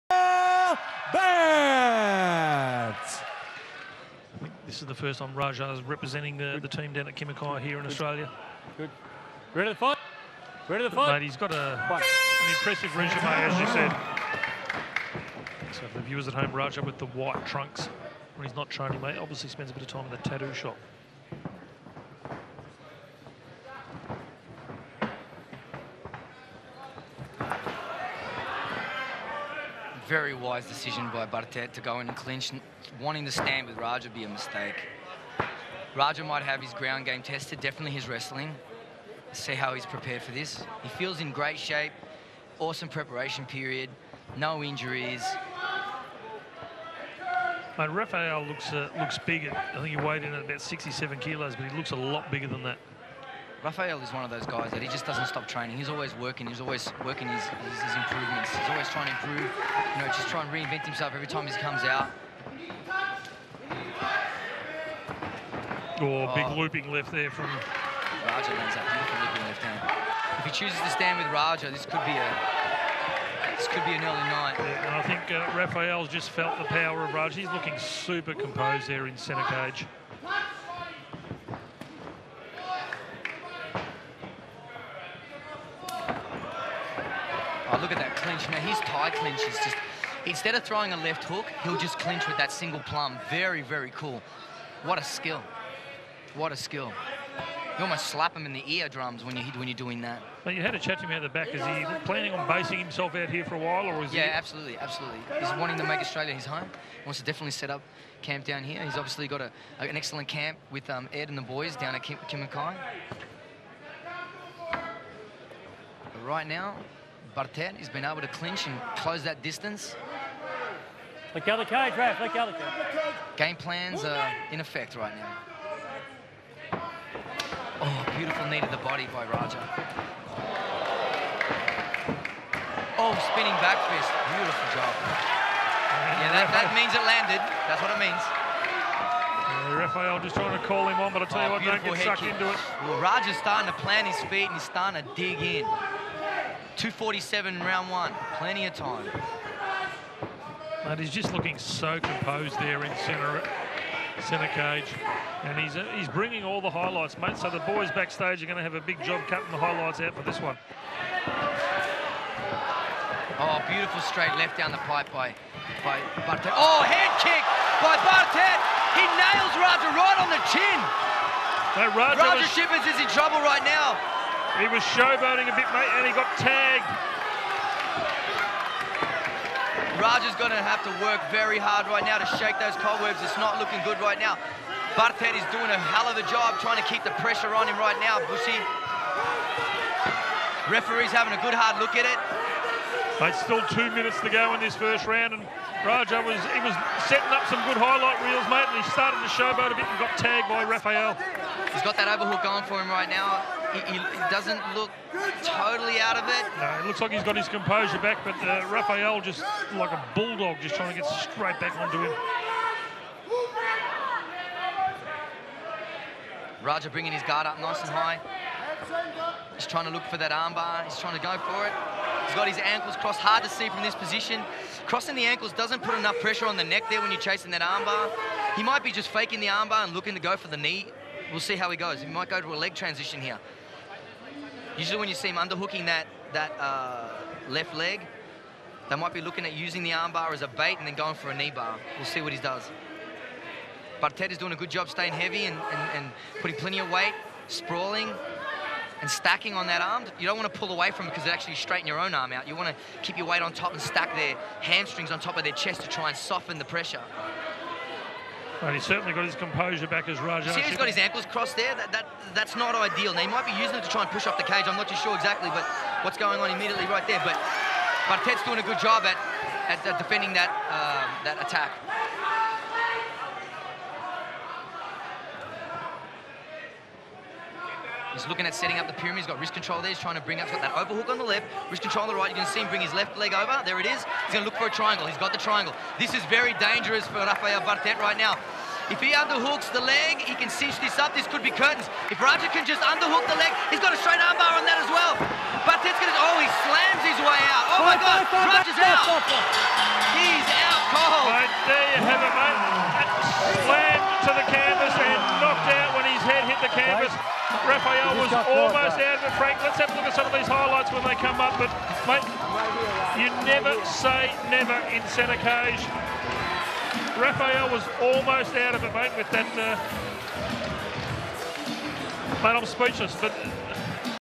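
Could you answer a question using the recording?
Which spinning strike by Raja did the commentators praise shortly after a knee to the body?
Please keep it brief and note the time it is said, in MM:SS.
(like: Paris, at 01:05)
spinning back fist, at 02:13.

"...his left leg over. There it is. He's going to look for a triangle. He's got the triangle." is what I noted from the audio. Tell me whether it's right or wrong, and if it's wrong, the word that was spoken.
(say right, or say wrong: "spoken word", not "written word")
right.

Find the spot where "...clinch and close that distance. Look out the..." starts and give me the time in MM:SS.
01:58.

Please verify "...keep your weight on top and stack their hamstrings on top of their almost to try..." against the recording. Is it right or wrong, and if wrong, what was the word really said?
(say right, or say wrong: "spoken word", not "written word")
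wrong: "chest", not "almost".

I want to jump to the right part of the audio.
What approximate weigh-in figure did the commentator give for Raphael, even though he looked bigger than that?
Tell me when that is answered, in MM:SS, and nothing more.
00:50.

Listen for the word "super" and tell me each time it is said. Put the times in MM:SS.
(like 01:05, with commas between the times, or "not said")
01:17.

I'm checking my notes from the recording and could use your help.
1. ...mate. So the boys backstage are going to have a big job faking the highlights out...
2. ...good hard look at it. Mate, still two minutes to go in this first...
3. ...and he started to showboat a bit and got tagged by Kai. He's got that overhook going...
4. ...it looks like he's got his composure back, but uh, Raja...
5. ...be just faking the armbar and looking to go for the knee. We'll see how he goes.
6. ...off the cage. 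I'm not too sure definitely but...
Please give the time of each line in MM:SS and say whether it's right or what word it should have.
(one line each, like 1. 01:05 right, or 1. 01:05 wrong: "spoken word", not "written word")
1. 02:37 wrong: "cutting", not "faking"
2. 03:11 right
3. 03:18 wrong: "Raphael", not "Kai"
4. 03:26 wrong: "Raphael", not "Raja"
5. 03:48 right
6. 04:24 wrong: "exactly", not "definitely".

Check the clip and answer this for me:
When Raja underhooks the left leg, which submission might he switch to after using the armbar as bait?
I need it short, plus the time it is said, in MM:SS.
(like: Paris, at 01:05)
knee bar, at 04:01.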